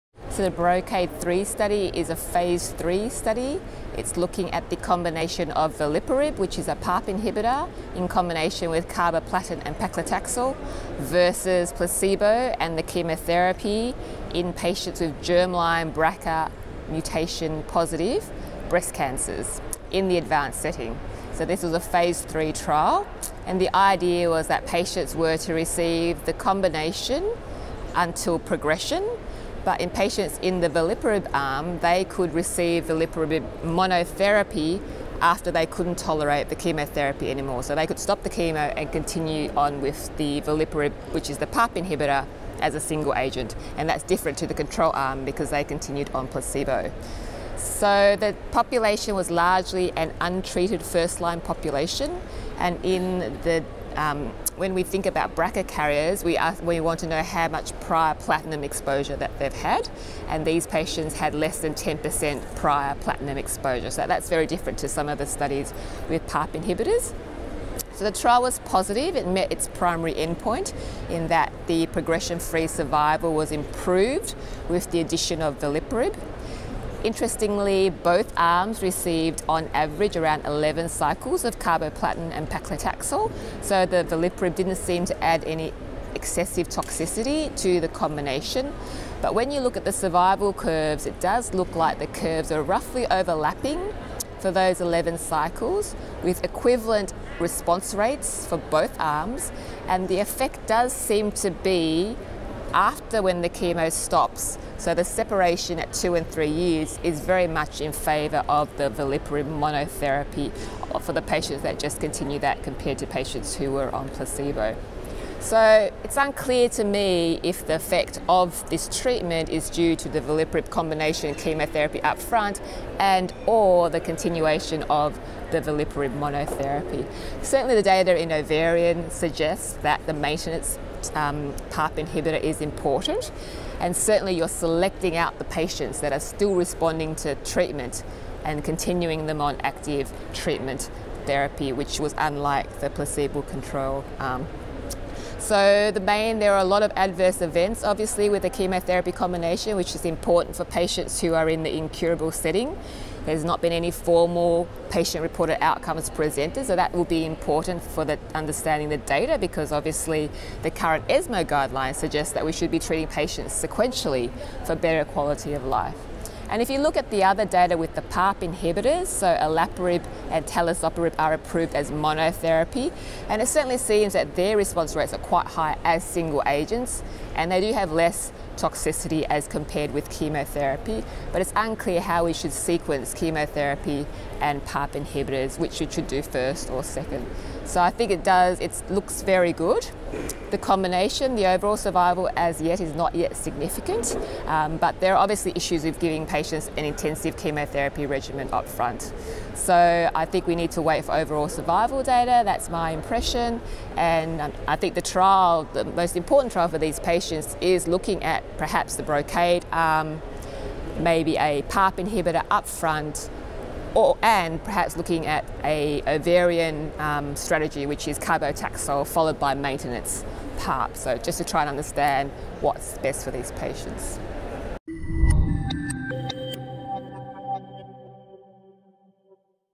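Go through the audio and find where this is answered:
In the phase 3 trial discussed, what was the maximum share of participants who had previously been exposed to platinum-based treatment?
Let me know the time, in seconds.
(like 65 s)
61 s.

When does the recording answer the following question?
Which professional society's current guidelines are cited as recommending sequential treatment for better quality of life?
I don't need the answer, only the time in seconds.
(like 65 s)
161 s.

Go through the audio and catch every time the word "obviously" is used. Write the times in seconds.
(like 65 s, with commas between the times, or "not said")
147 s, 159 s, 195 s.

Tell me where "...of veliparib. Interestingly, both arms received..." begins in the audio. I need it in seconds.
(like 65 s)
75 s.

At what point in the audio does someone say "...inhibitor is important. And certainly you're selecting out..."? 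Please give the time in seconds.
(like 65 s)
131 s.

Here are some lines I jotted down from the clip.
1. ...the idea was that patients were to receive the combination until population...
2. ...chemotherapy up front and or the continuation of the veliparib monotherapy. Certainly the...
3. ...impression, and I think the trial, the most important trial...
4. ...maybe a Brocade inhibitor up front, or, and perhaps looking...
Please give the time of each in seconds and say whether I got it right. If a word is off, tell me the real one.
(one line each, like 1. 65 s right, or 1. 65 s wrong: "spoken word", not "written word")
1. 23 s wrong: "progression", not "population"
2. 121 s right
3. 202 s right
4. 211 s wrong: "PARP", not "Brocade".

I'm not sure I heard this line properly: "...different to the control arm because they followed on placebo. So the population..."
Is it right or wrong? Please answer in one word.
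wrong.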